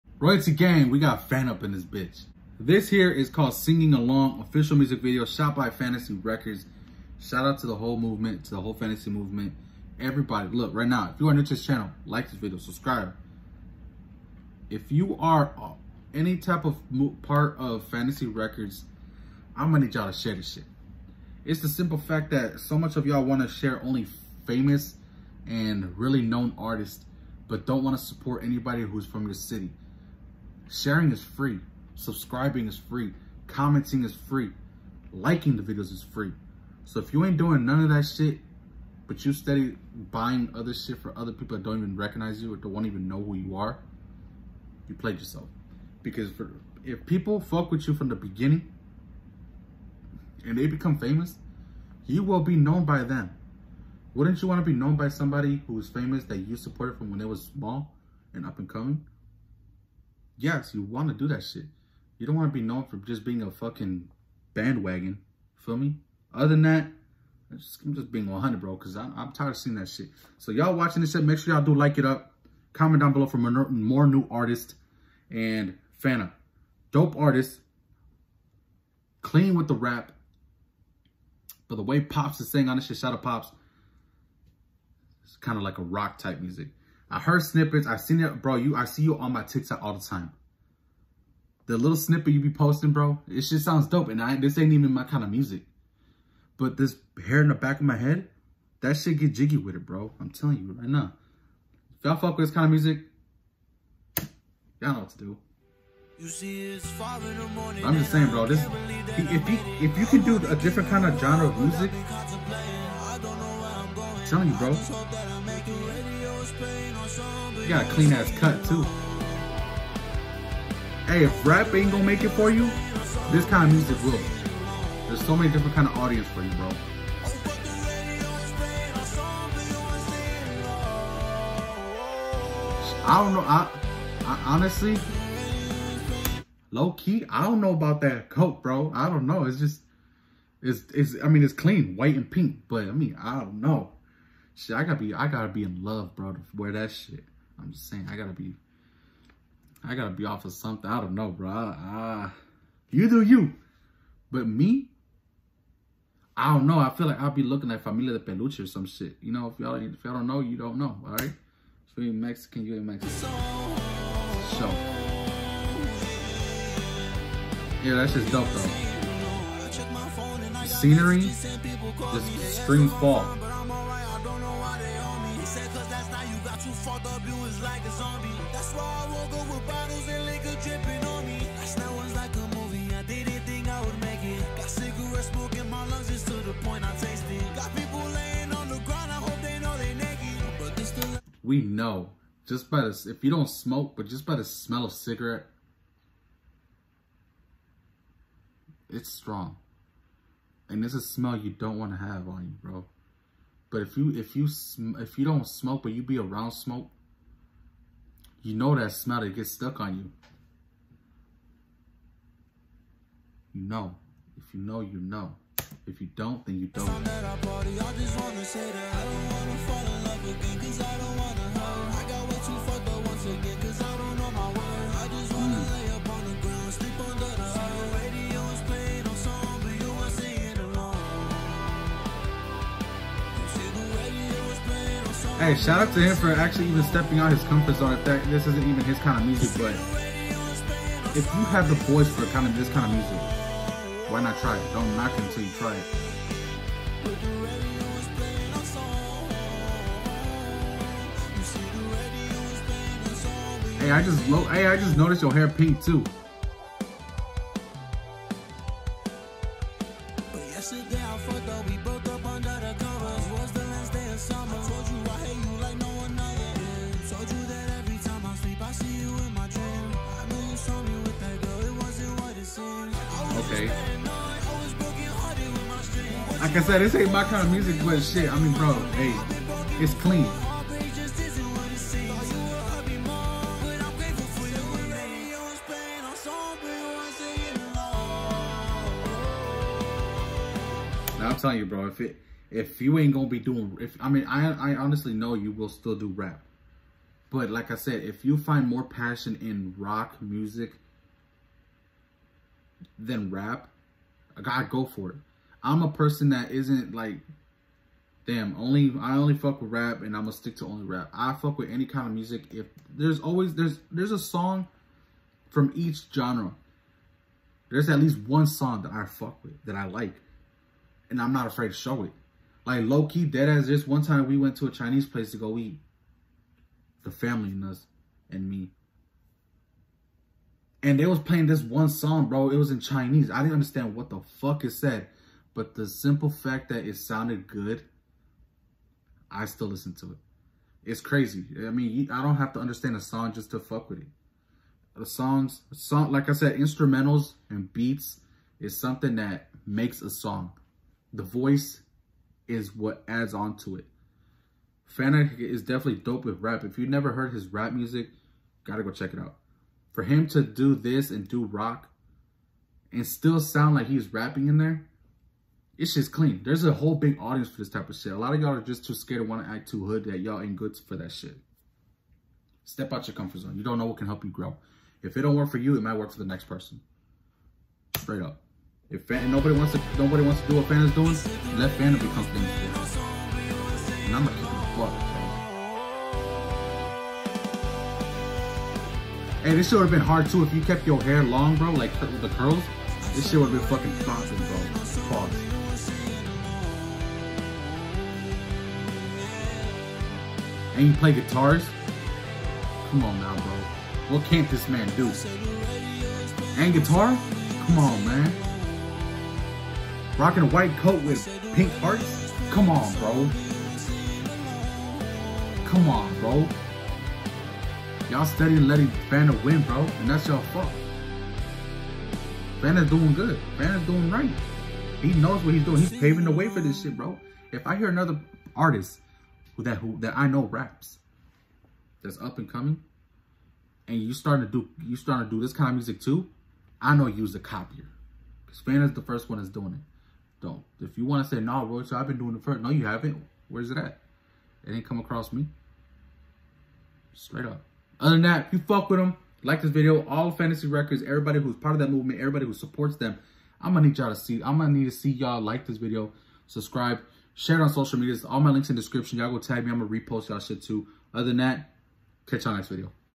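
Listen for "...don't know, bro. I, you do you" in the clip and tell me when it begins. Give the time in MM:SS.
02:31.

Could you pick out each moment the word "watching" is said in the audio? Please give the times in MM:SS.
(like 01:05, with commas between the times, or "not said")
01:10.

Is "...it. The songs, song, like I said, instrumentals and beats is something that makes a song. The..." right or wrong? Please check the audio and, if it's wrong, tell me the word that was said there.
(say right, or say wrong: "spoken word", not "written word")
right.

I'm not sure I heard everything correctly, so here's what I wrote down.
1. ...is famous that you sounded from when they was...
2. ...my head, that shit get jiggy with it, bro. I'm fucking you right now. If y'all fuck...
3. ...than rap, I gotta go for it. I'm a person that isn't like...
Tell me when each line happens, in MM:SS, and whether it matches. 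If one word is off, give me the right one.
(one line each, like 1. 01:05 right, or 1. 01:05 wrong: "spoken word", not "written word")
1. 00:55 wrong: "supported", not "sounded"
2. 01:37 wrong: "telling", not "fucking"
3. 05:02 right.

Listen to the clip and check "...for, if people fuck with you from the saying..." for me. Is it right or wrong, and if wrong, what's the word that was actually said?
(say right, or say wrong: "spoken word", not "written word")
wrong: "beginning", not "saying".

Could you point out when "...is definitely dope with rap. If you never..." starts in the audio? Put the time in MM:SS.
05:55.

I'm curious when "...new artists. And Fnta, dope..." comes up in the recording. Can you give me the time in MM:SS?
01:14.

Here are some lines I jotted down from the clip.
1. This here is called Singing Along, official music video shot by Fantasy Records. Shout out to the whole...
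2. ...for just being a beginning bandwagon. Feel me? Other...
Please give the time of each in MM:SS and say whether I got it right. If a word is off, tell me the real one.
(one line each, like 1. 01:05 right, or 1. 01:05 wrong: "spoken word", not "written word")
1. 00:02 right
2. 01:02 wrong: "fucking", not "beginning".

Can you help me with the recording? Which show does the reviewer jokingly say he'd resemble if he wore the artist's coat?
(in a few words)
Familia de Peluche.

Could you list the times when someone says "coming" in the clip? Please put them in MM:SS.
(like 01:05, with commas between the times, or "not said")
00:58, 07:12.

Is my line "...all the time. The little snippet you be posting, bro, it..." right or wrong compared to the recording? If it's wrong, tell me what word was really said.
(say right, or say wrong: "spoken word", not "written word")
right.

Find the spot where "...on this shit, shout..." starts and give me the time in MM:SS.
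01:22.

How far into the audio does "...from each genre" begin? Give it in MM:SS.
05:15.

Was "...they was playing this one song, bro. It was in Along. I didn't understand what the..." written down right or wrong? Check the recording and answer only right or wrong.
wrong.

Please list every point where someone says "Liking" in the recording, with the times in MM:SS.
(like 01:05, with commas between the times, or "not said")
00:35.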